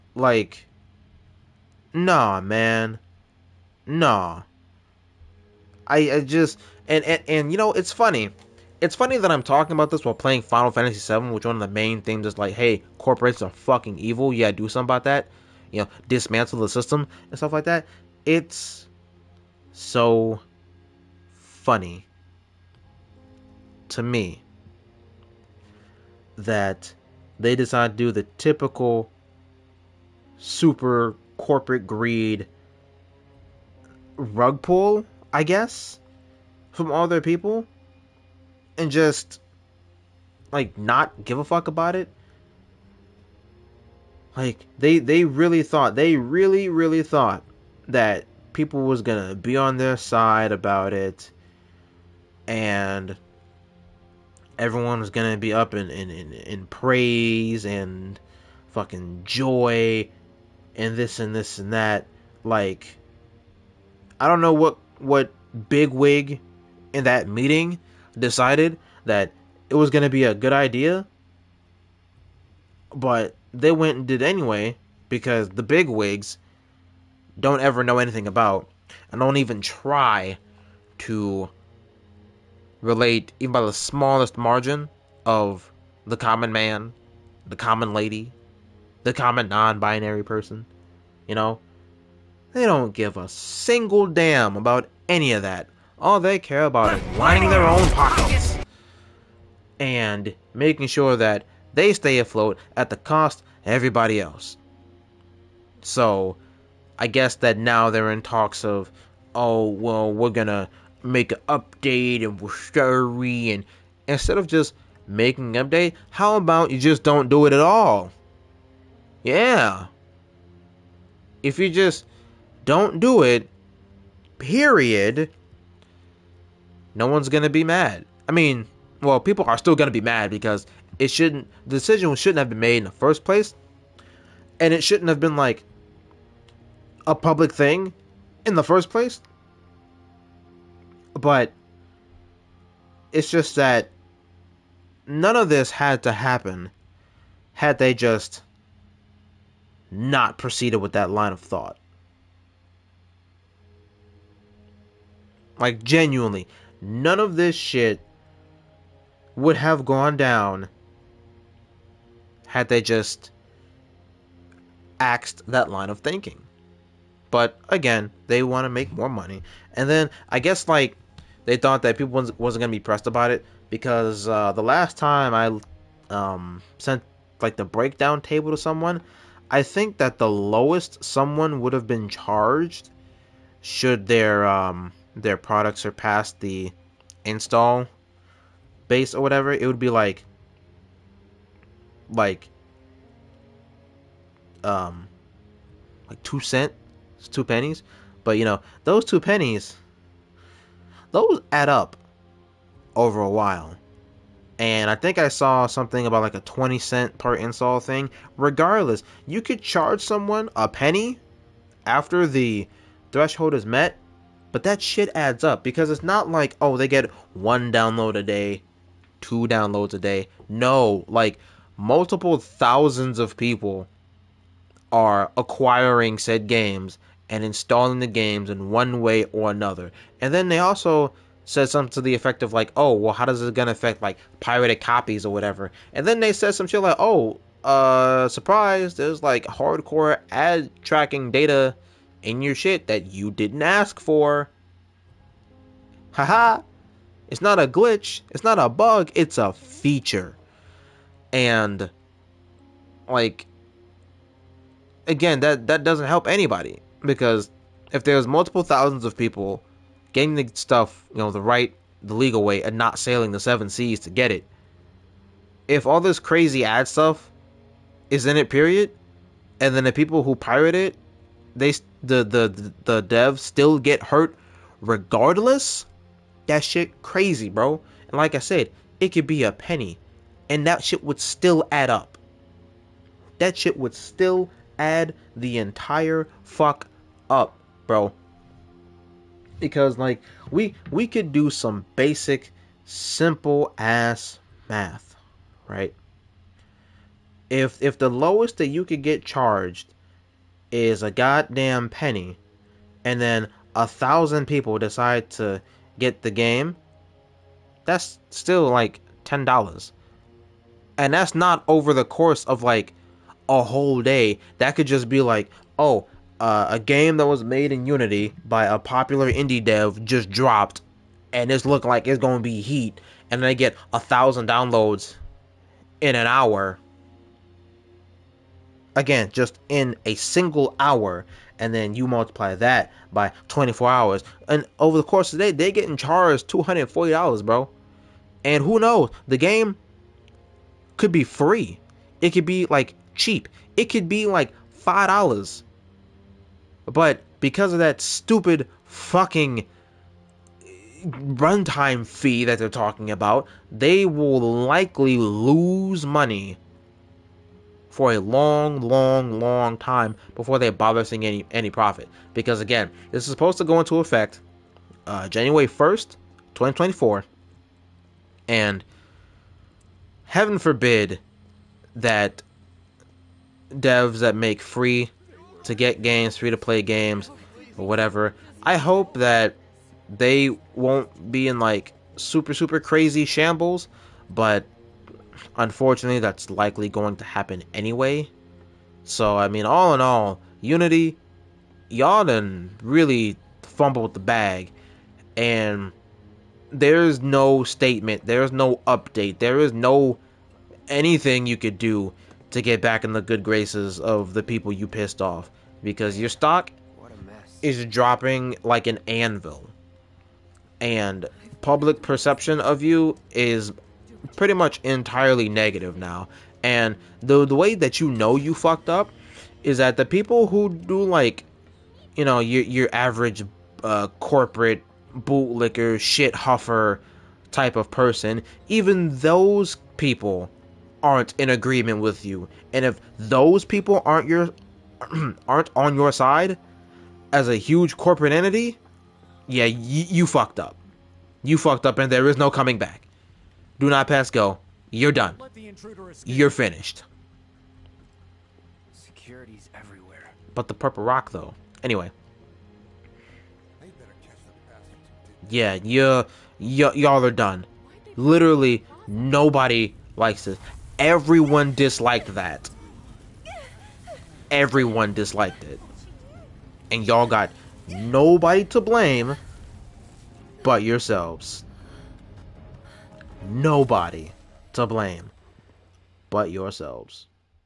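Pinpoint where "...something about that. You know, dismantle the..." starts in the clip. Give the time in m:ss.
0:14.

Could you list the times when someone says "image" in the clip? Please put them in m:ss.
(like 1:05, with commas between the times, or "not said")
not said.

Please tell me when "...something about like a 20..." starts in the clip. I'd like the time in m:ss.
3:25.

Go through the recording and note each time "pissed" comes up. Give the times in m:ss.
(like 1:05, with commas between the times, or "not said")
6:44.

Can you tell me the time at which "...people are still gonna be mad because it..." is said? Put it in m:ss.
2:09.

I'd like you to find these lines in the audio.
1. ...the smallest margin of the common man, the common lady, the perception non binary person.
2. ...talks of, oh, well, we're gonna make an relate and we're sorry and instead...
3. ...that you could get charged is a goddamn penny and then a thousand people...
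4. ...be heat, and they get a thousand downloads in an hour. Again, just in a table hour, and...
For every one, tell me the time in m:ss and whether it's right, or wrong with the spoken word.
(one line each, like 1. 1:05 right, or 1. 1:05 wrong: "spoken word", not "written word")
1. 1:23 wrong: "common", not "perception"
2. 1:48 wrong: "update", not "relate"
3. 4:58 right
4. 5:22 wrong: "single", not "table".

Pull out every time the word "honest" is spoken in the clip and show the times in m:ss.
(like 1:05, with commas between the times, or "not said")
not said.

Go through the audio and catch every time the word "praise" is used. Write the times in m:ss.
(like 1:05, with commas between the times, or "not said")
0:56.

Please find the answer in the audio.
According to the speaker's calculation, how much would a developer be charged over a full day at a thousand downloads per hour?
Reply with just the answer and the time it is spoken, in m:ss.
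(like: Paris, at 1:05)
$240, at 5:36.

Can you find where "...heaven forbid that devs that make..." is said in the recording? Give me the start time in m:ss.
6:10.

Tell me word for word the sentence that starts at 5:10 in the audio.
And that's not over the course of like a whole day.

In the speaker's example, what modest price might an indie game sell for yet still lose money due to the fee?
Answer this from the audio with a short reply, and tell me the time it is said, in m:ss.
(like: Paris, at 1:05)
$5, at 5:44.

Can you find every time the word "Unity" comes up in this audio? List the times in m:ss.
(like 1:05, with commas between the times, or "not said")
5:17, 6:30.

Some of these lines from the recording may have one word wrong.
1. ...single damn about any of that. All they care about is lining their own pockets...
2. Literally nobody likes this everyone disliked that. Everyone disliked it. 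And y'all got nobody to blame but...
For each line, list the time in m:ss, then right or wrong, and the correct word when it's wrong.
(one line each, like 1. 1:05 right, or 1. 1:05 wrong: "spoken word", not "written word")
1. 1:33 right
2. 7:38 right.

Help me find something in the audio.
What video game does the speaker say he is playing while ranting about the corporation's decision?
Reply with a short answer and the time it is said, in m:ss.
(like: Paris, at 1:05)
Final Fantasy VII, at 0:10.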